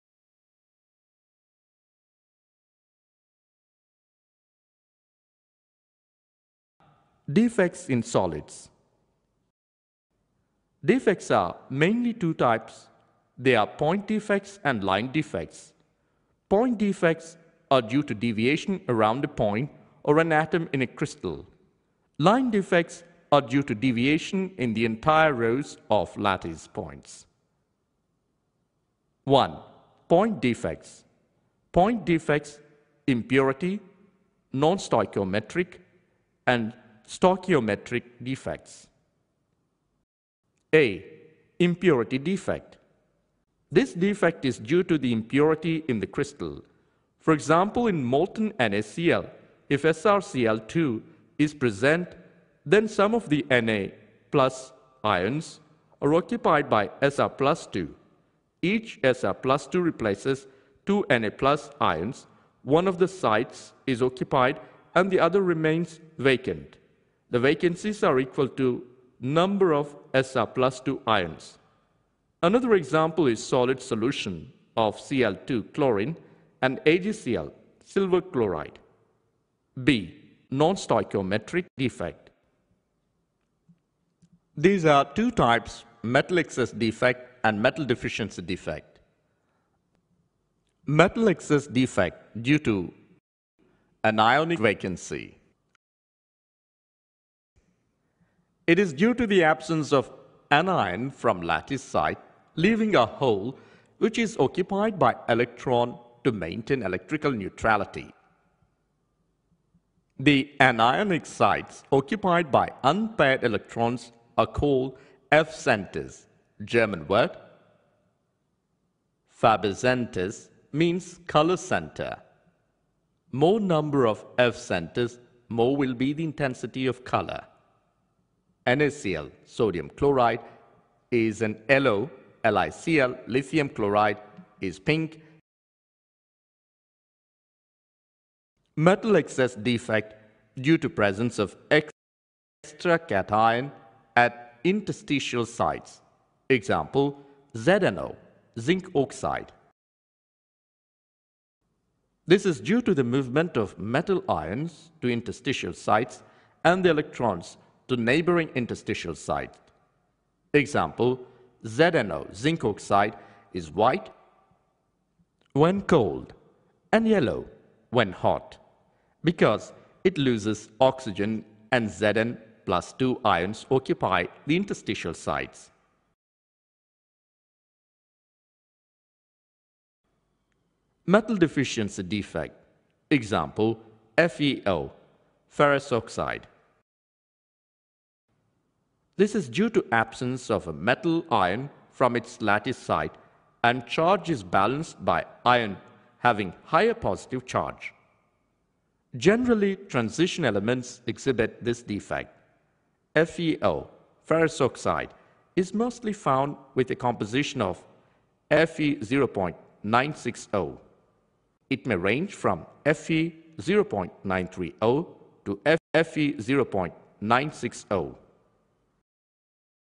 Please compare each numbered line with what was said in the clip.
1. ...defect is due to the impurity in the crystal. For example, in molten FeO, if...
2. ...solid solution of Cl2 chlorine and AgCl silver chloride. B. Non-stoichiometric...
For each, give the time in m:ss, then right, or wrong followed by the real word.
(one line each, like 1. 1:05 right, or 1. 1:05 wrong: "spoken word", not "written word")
1. 0:43 wrong: "NaCl", not "FeO"
2. 1:13 right.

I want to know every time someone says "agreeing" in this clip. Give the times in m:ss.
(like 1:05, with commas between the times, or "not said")
not said.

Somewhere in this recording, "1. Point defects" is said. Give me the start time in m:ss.
0:29.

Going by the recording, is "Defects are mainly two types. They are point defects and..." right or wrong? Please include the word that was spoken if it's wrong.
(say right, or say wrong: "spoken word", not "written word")
right.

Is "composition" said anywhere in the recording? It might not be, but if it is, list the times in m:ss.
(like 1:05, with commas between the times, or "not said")
3:26.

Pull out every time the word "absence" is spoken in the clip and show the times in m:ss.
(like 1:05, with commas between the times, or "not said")
1:39, 3:09.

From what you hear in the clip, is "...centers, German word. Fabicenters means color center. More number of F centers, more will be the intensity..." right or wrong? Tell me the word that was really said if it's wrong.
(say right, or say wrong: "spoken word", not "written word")
right.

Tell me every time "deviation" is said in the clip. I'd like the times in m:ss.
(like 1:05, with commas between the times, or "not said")
0:18, 0:23.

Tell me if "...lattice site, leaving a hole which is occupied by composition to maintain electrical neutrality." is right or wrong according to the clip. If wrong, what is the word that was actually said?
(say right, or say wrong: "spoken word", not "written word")
wrong: "electron", not "composition".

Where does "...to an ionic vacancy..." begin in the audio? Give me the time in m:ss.
1:32.